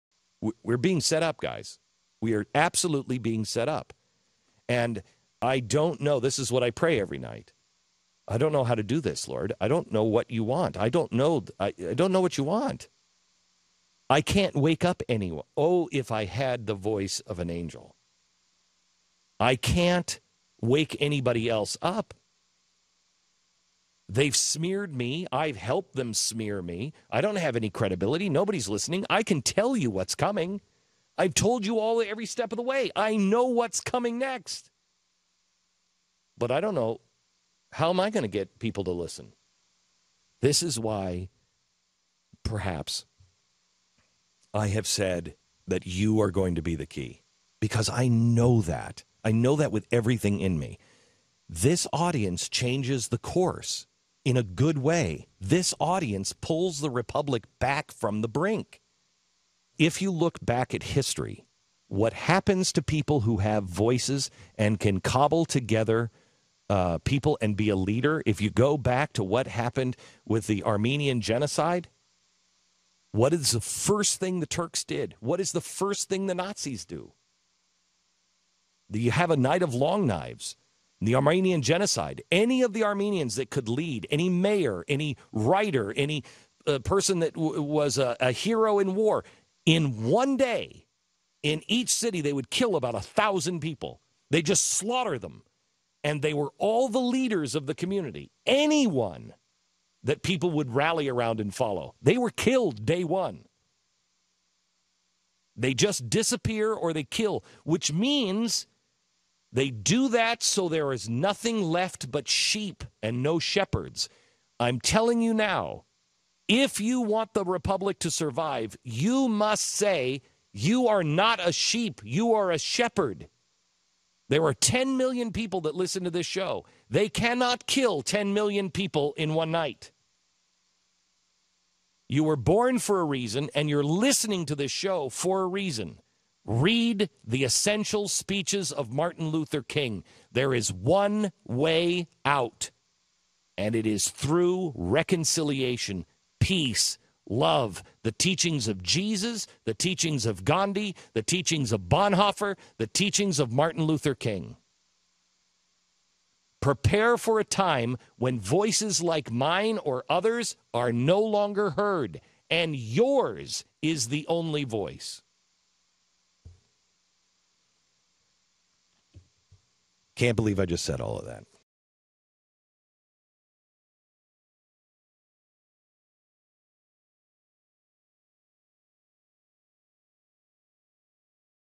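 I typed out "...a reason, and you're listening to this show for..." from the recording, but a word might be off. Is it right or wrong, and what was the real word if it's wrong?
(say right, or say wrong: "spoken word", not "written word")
right.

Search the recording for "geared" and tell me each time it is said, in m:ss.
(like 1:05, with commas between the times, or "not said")
not said.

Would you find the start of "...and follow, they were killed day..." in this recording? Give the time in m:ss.
1:41.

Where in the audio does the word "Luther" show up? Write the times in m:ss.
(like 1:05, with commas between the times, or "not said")
2:19, 2:33.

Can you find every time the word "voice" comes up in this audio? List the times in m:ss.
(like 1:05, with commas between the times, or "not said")
0:16, 1:03, 2:38, 2:44.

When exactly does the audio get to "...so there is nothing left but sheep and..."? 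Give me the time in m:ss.
1:50.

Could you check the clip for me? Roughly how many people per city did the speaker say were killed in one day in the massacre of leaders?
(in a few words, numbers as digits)
1000.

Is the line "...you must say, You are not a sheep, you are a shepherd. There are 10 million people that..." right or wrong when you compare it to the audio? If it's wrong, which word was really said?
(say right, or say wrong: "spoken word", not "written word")
right.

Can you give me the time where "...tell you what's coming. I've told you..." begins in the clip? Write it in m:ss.
0:29.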